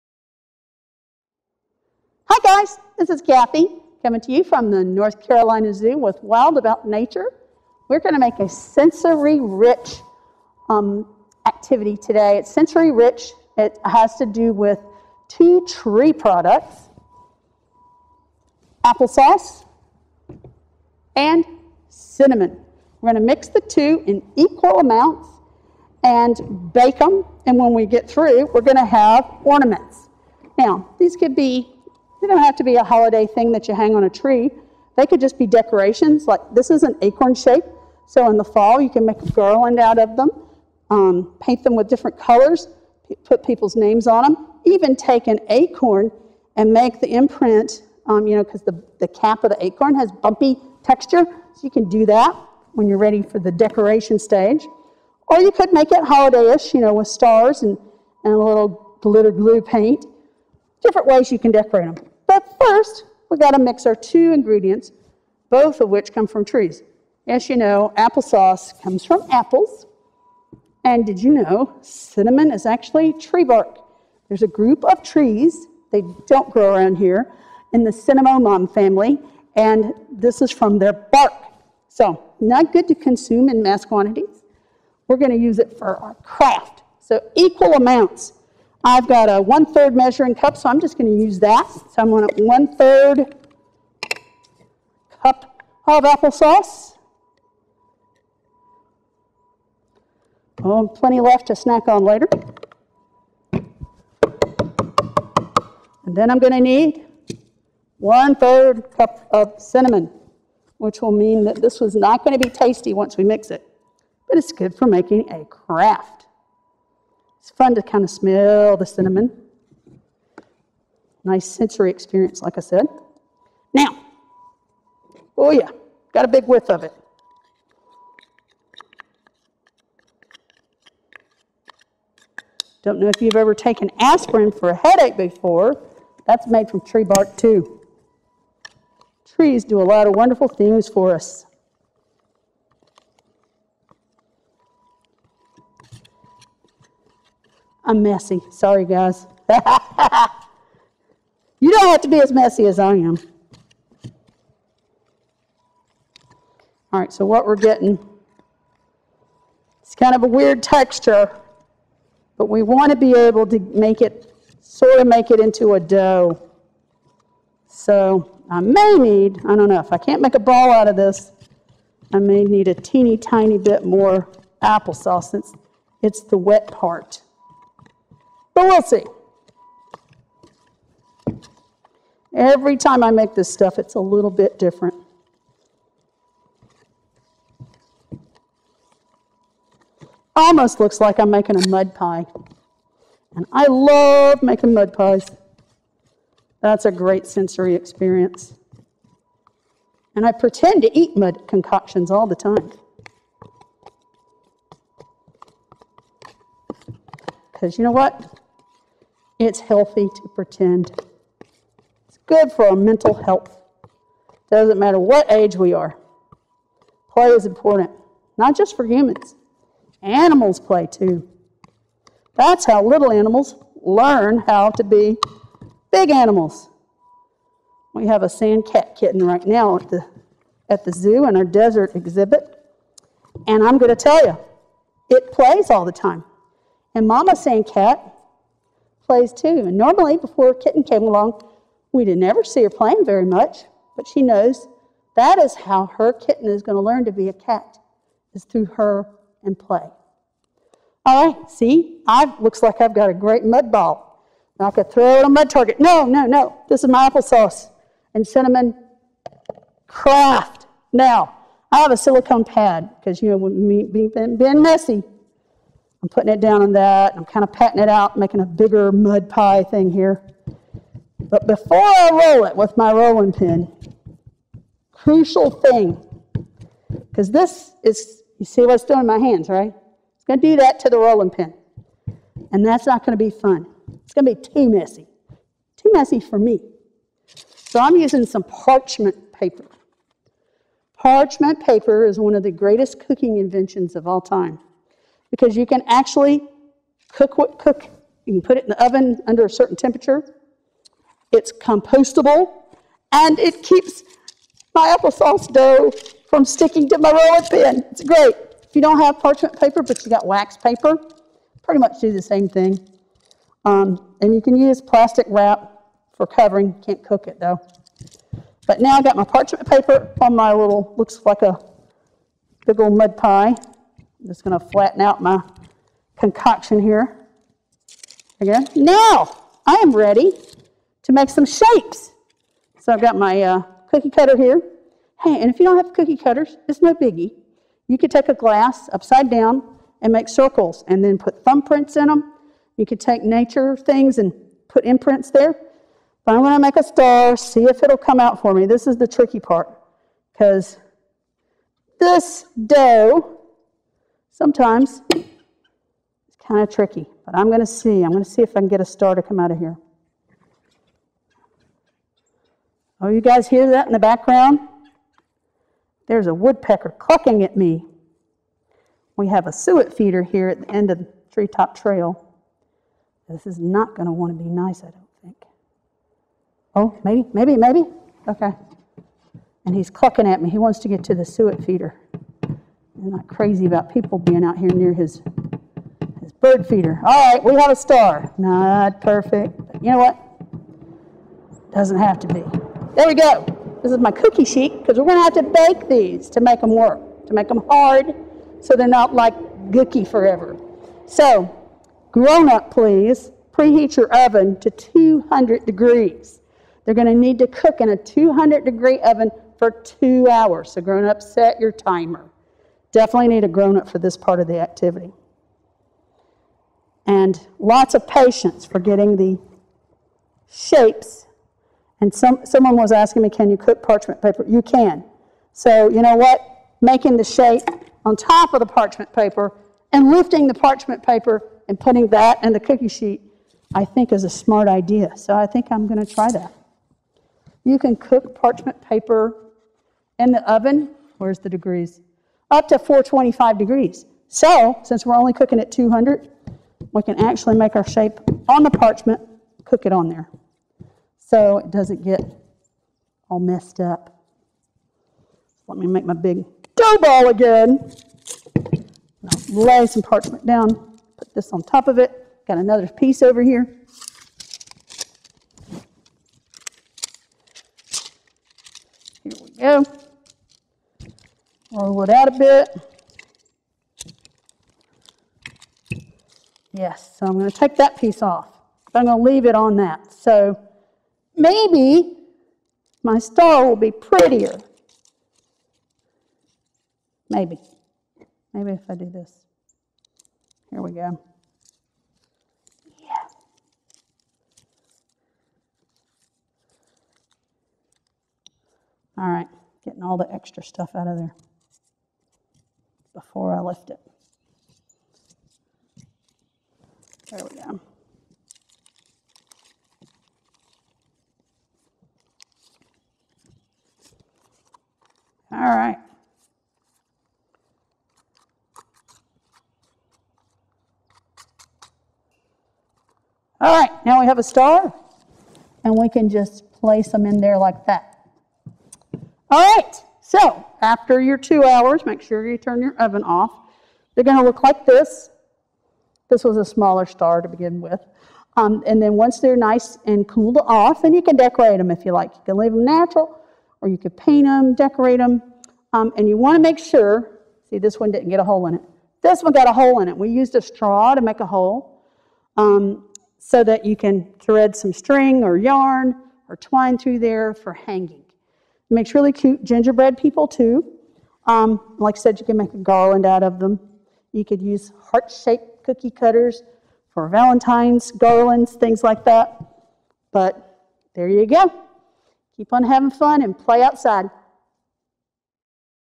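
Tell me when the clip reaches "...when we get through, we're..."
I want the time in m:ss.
0:27.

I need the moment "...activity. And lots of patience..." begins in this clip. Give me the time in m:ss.
6:54.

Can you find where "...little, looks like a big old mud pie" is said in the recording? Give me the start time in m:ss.
5:20.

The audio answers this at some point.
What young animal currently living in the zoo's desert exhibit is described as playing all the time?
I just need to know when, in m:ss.
3:48.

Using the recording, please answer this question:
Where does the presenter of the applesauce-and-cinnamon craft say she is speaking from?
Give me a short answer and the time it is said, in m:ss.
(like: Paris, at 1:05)
North Carolina Zoo, at 0:04.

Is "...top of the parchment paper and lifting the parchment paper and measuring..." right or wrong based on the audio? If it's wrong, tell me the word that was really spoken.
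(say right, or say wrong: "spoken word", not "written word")
wrong: "putting", not "measuring".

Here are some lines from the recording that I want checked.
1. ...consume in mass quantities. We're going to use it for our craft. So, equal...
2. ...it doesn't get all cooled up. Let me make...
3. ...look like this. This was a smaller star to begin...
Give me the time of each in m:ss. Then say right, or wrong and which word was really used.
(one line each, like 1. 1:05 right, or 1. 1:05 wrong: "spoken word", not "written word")
1. 1:22 right
2. 7:31 wrong: "messed", not "cooled"
3. 8:54 right.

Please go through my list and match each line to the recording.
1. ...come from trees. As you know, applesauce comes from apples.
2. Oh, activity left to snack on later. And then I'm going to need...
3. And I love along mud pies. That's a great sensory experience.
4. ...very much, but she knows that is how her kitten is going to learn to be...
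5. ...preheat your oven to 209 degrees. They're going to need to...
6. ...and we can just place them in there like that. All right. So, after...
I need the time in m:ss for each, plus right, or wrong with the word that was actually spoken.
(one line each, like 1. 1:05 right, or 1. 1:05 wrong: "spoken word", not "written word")
1. 1:06 right
2. 1:40 wrong: "plenty", not "activity"
3. 3:13 wrong: "making", not "along"
4. 4:03 right
5. 6:43 wrong: "200", not "209"
6. 8:45 right.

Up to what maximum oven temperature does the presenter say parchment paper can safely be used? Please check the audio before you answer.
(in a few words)
425 degrees.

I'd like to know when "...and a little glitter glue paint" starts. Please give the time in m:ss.
0:58.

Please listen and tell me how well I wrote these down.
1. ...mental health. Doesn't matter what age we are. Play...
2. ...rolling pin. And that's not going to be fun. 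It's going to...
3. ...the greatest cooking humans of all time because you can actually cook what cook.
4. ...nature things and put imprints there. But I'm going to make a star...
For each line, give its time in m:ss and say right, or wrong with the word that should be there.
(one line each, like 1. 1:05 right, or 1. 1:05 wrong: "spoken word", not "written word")
1. 3:32 right
2. 4:40 right
3. 4:52 wrong: "inventions", not "humans"
4. 5:43 right.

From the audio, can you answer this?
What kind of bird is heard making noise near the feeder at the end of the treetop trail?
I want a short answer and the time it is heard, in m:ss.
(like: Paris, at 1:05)
woodpecker, at 6:06.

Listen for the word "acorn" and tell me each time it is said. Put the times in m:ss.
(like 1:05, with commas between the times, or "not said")
0:37, 0:45, 0:49.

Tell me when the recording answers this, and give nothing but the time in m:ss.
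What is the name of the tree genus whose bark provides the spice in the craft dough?
1:17.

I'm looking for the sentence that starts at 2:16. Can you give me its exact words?
That's made from tree bark, too.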